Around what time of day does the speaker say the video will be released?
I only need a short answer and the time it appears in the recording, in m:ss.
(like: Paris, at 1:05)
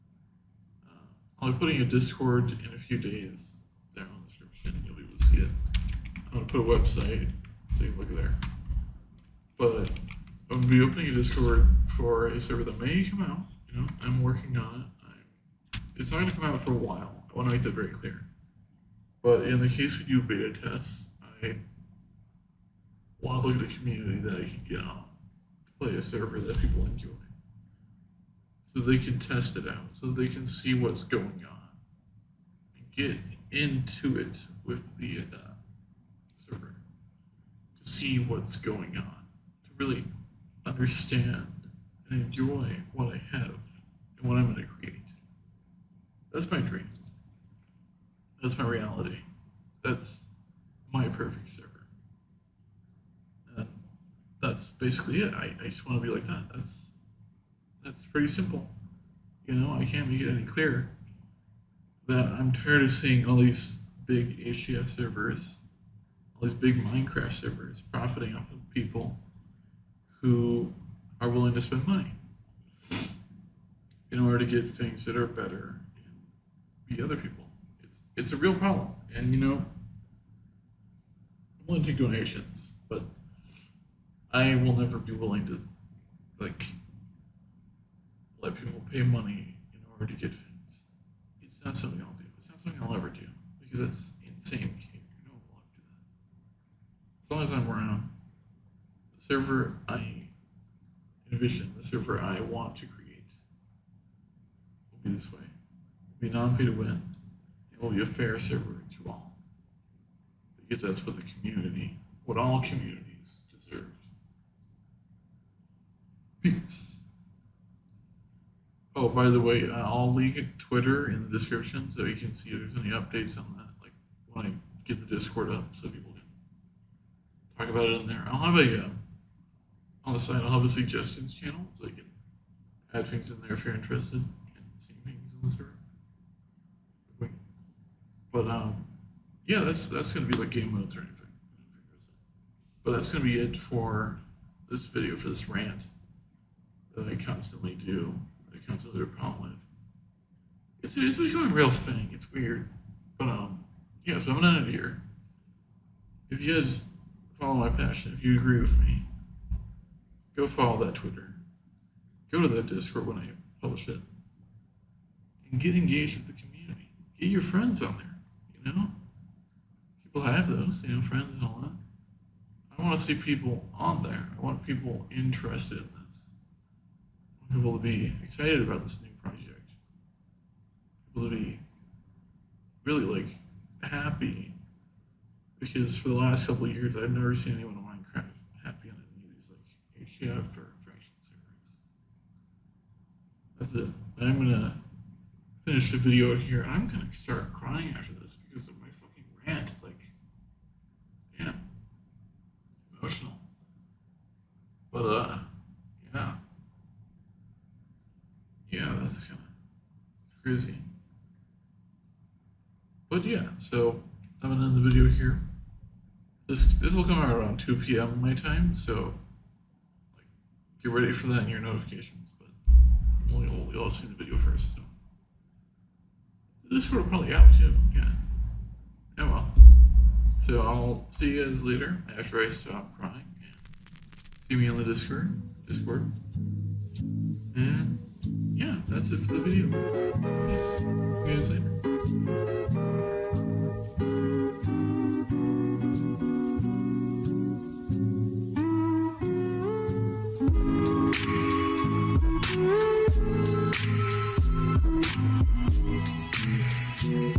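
2 p.m., at 3:37.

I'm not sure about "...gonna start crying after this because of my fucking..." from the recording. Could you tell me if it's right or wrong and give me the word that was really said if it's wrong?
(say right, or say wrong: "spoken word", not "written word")
right.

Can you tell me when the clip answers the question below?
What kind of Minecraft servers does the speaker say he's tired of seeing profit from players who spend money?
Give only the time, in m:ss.
1:04.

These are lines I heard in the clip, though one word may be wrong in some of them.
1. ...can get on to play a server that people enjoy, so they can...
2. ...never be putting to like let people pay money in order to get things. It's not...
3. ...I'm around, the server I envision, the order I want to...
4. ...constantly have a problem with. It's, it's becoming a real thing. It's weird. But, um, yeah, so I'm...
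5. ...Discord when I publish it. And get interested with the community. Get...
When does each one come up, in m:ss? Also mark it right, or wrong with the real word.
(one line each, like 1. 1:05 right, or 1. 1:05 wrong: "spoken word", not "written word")
1. 0:24 right
2. 1:24 wrong: "willing", not "putting"
3. 1:37 wrong: "server", not "order"
4. 2:28 right
5. 2:42 wrong: "engaged", not "interested".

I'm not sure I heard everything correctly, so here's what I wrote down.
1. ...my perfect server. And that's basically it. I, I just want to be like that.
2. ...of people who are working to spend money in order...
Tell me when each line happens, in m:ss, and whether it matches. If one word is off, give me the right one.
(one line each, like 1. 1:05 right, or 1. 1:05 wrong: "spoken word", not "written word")
1. 0:50 right
2. 1:08 wrong: "willing", not "working".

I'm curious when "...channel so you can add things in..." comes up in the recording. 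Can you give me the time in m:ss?
2:11.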